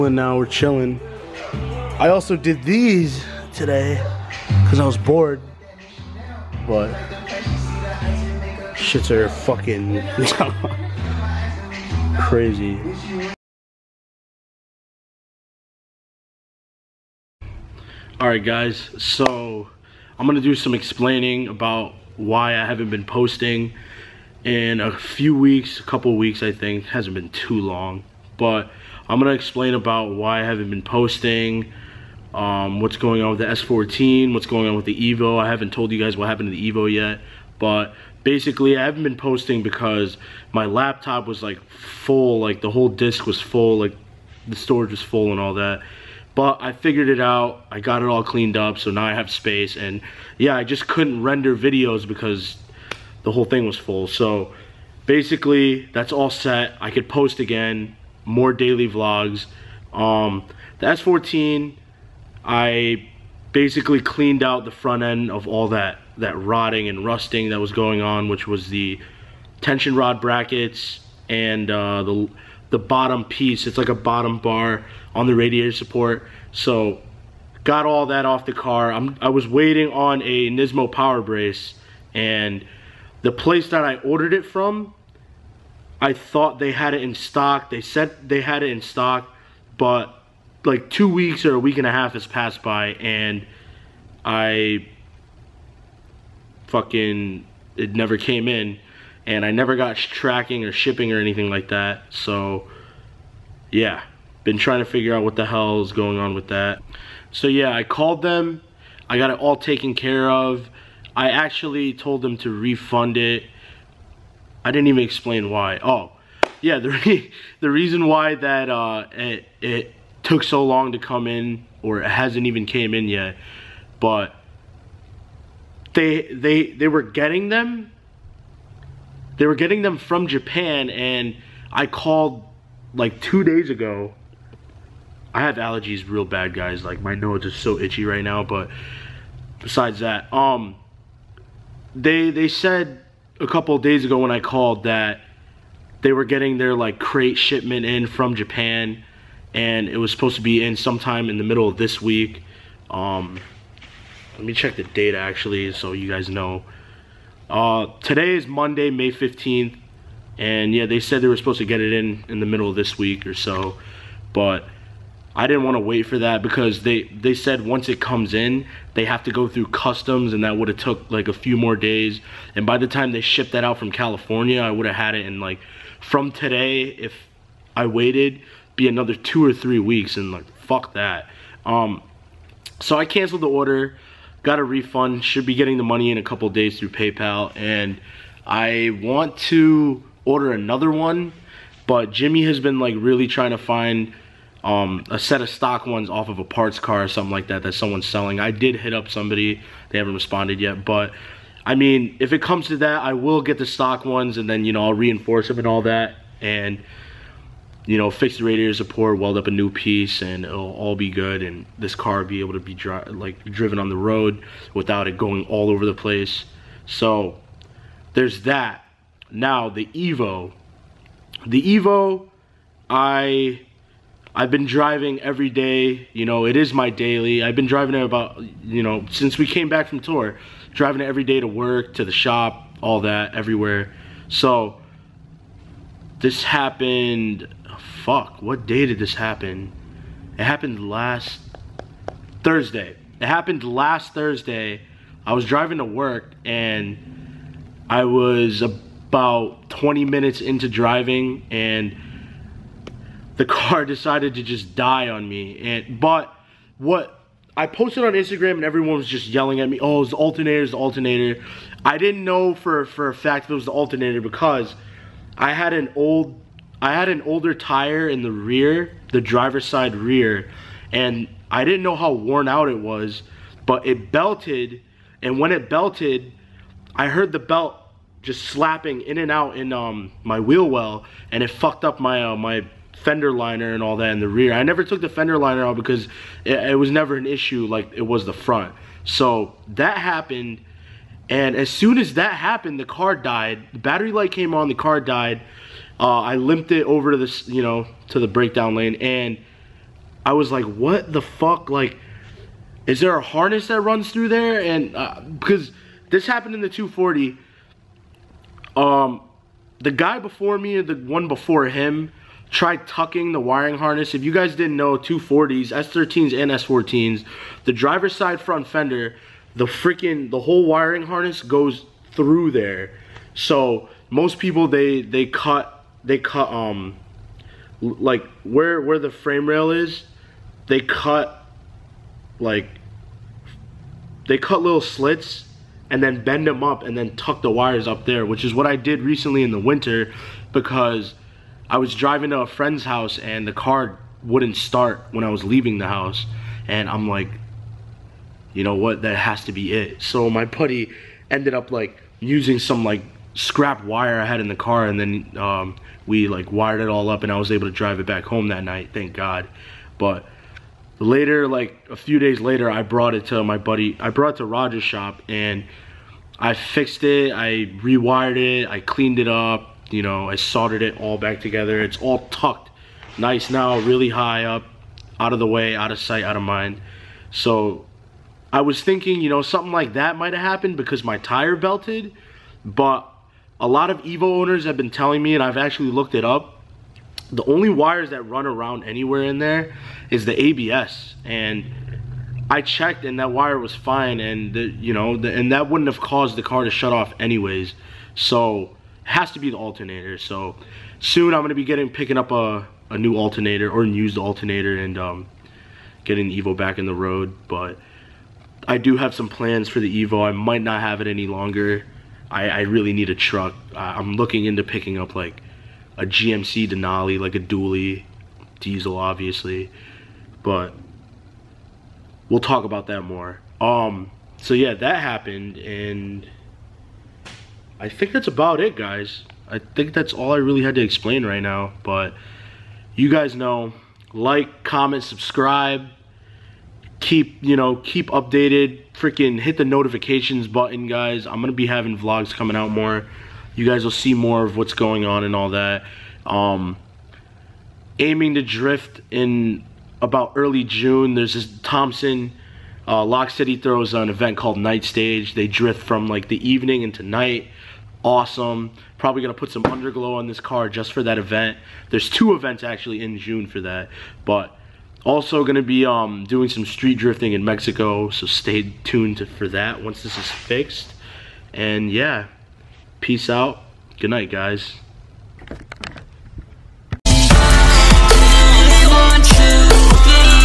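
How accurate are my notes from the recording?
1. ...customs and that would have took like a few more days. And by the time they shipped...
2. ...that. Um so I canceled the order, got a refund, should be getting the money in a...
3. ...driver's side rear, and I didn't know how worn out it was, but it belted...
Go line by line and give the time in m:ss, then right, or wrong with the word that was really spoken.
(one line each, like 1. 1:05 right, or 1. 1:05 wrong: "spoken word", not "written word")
1. 2:49 right
2. 3:00 right
3. 4:29 right.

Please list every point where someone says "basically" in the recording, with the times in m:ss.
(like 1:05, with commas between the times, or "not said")
0:38, 0:55, 1:03.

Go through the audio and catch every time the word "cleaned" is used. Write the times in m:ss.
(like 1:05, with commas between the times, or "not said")
0:48, 1:04, 6:08.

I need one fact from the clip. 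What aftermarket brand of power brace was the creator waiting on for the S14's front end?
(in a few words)
Nismo.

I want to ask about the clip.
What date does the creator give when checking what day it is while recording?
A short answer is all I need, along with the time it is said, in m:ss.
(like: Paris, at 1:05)
Monday, May 15th, at 2:38.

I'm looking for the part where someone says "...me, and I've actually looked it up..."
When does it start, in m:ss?
6:25.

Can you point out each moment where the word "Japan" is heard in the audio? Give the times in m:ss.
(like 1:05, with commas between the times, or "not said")
2:10, 2:28.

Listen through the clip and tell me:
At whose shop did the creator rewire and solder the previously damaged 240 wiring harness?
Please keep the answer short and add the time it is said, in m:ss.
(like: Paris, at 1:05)
Roger's, at 6:04.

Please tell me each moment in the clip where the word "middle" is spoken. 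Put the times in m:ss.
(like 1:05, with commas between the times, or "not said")
2:31, 2:42.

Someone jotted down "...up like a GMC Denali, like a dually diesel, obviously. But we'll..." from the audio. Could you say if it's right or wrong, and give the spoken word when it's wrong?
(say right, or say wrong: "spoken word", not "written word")
right.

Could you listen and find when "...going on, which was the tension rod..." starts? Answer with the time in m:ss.
1:07.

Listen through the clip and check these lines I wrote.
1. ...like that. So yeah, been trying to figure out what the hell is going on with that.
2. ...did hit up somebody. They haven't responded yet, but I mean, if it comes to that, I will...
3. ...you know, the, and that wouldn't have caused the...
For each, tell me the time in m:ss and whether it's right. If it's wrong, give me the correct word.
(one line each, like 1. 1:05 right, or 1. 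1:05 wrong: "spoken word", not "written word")
1. 1:41 right
2. 3:18 right
3. 6:34 right.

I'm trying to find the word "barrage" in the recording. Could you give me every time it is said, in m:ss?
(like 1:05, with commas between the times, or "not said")
not said.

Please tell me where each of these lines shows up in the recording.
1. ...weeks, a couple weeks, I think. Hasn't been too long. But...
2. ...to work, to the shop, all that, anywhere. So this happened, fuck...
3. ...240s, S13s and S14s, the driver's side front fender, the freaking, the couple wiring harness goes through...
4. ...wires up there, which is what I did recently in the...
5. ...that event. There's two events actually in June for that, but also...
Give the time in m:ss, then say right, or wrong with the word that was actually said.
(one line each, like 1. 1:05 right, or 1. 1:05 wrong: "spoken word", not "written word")
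1. 0:25 right
2. 3:51 wrong: "everywhere", not "anywhere"
3. 5:14 wrong: "whole", not "couple"
4. 5:37 right
5. 7:41 right.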